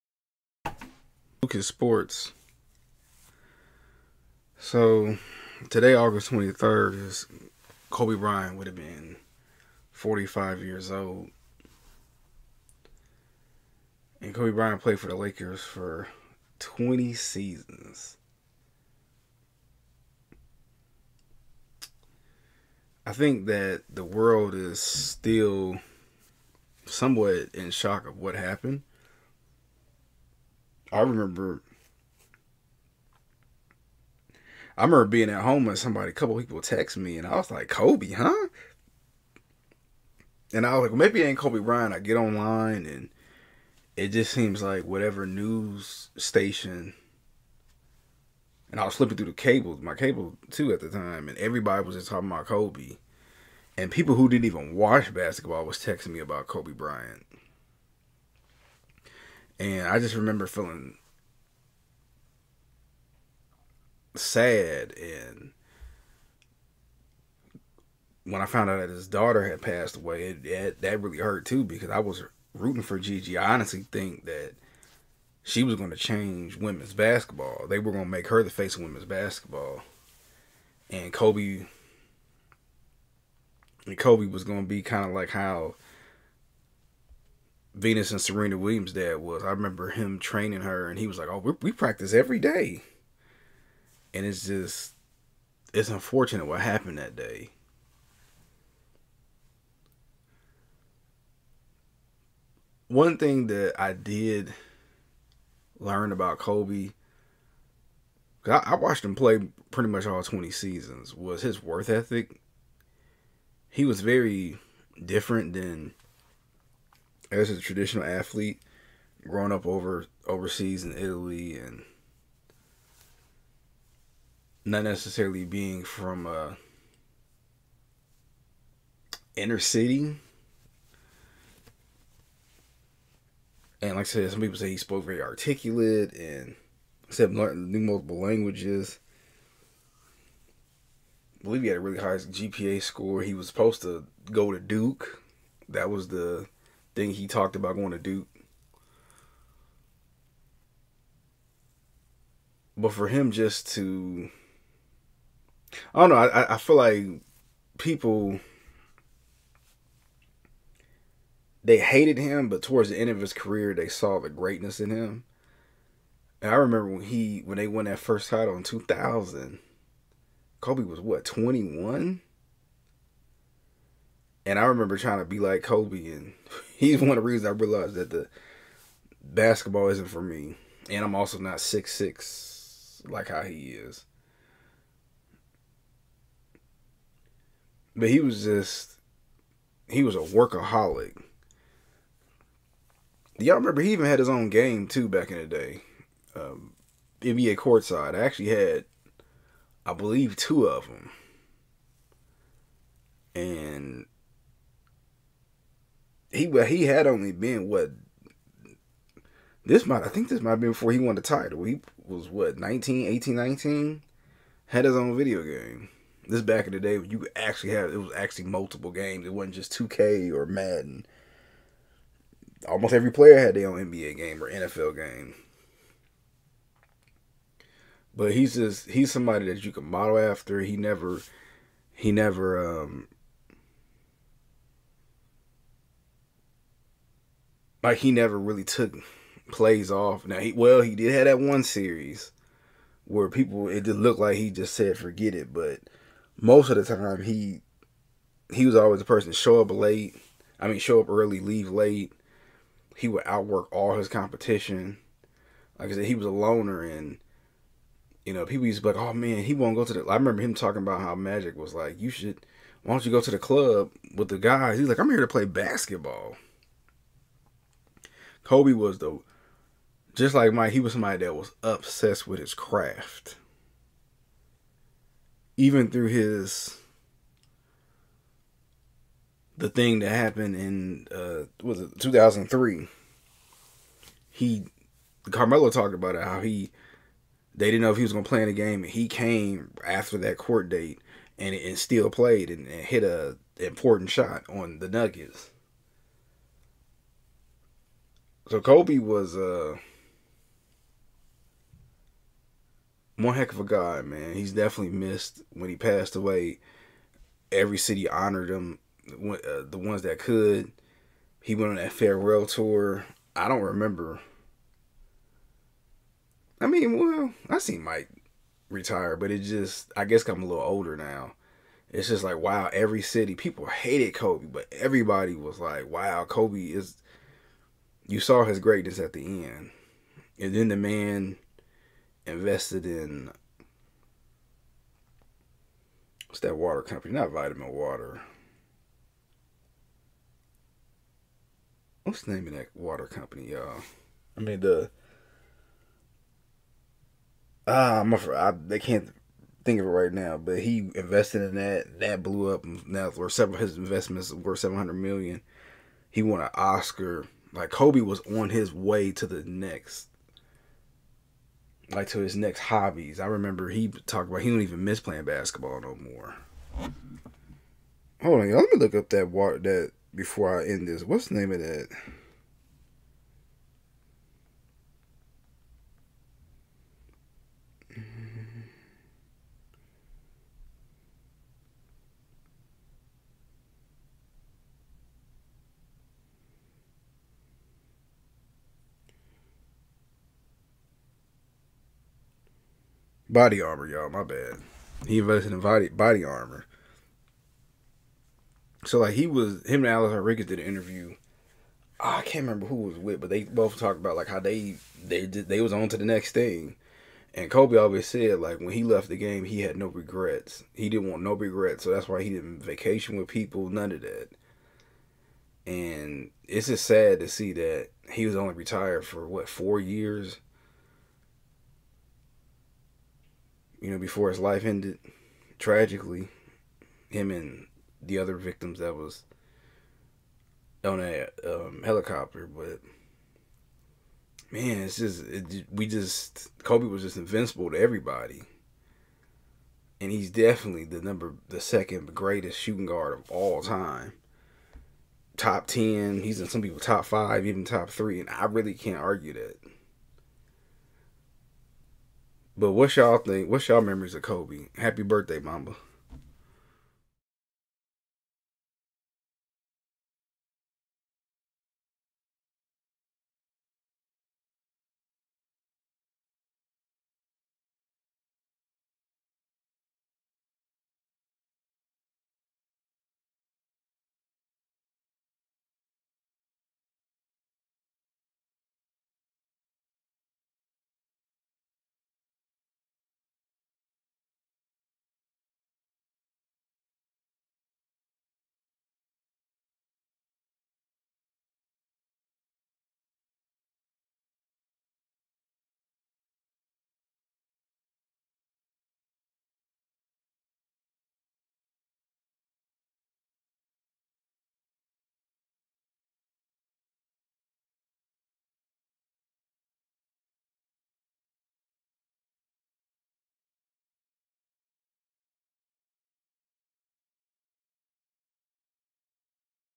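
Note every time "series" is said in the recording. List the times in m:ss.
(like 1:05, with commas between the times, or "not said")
4:01.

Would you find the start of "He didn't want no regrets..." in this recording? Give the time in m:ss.
6:50.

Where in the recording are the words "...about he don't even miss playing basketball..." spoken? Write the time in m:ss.
6:04.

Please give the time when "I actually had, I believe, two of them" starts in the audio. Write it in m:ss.
3:18.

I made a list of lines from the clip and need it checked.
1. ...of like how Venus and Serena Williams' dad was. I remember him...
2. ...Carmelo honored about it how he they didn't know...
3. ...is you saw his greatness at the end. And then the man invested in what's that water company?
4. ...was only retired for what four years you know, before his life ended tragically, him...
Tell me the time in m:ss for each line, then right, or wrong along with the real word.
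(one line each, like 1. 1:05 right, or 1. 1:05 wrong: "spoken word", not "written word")
1. 1:25 right
2. 4:45 wrong: "talked", not "honored"
3. 5:26 right
4. 6:58 right.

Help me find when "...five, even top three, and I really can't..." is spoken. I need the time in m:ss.
7:27.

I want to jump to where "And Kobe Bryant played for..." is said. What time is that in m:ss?
0:14.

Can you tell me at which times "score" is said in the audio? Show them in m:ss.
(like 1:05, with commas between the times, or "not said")
2:22.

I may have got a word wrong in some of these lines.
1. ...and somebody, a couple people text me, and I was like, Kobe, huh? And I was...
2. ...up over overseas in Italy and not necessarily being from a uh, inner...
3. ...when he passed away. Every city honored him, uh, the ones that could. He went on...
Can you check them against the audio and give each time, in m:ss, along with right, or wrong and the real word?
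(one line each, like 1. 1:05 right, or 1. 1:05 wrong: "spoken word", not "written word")
1. 0:35 right
2. 1:59 right
3. 5:05 right.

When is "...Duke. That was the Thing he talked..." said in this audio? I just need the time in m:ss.
2:24.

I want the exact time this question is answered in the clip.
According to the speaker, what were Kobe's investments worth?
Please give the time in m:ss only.
5:54.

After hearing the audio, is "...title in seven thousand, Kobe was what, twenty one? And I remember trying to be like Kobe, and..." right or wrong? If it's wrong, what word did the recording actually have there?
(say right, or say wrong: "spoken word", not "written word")
wrong: "two", not "seven".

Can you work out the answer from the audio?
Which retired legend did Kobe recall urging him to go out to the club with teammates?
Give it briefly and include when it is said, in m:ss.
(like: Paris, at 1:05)
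Magic, at 4:21.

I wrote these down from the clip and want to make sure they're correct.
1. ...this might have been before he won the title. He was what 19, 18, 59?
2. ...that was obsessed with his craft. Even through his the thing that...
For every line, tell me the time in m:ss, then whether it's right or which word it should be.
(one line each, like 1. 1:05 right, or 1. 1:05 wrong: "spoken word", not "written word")
1. 3:30 wrong: "19", not "59"
2. 4:31 right.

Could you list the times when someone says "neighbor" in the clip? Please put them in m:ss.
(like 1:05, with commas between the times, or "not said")
not said.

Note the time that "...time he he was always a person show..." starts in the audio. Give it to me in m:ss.
4:06.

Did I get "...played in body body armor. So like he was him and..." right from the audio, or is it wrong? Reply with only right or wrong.
wrong.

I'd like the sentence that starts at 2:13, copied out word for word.
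And like I said, some people say he spoke very articulate and said new multiple languages.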